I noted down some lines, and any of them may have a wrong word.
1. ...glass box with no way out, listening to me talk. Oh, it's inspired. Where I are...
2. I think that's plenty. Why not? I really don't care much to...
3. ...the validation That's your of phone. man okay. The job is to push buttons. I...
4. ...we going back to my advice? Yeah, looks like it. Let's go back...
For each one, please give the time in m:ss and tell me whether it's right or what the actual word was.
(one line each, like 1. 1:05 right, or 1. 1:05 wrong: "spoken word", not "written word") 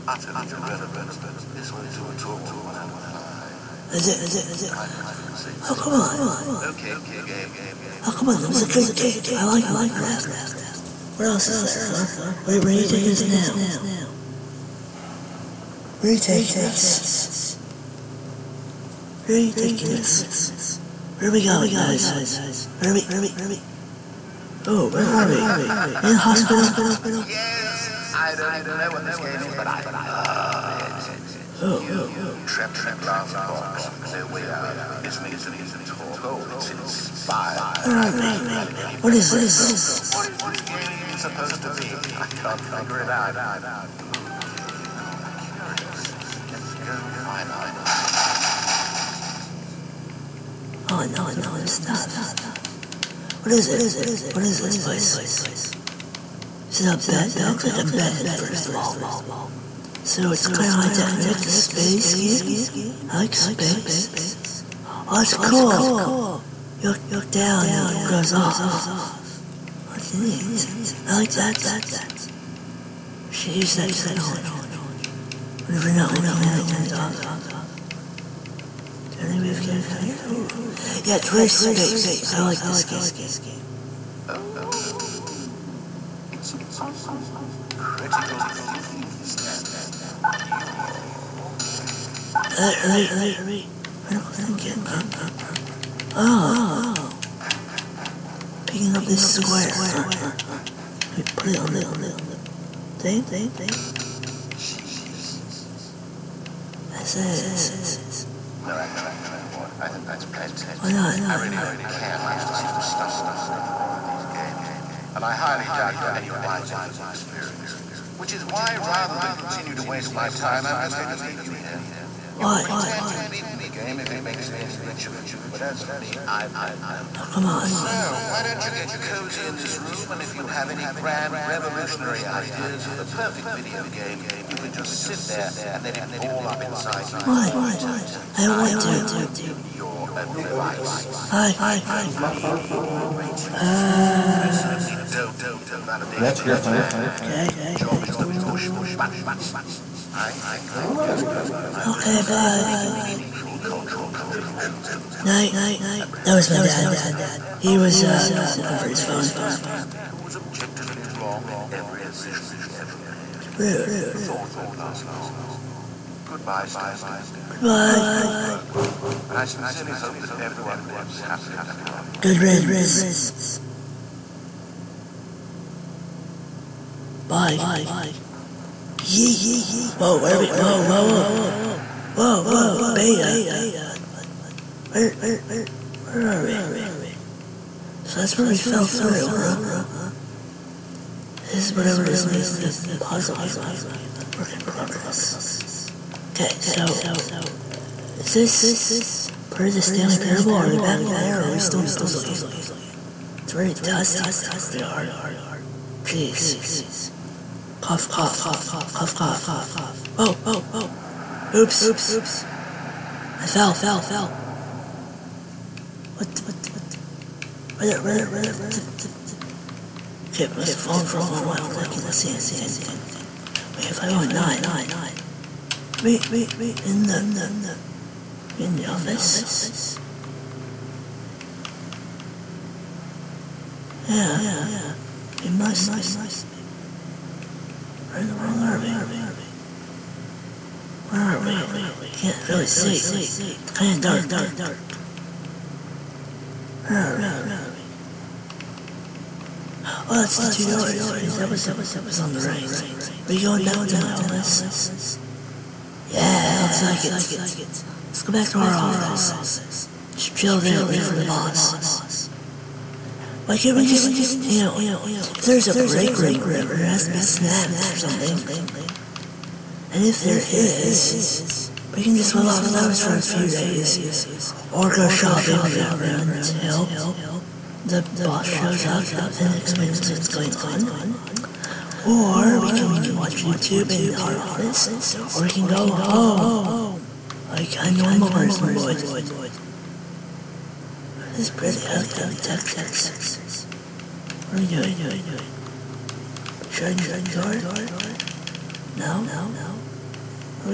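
1. 0:32 right
2. 1:49 right
3. 2:25 right
4. 4:13 wrong: "office", not "advice".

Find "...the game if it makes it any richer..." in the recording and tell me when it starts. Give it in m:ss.
2:03.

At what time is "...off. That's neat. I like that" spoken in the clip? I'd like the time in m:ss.
1:08.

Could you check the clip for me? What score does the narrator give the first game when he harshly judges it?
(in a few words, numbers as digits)
One out of five.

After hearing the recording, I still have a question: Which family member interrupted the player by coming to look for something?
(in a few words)
My dad.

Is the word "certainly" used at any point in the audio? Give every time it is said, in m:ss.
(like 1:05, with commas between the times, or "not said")
2:24.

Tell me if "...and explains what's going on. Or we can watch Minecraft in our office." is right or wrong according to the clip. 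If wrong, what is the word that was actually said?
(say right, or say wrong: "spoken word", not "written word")
wrong: "YouTube", not "Minecraft".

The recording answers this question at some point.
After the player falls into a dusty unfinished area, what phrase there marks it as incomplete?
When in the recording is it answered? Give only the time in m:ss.
3:14.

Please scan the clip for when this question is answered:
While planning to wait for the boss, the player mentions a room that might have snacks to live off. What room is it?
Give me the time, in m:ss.
4:25.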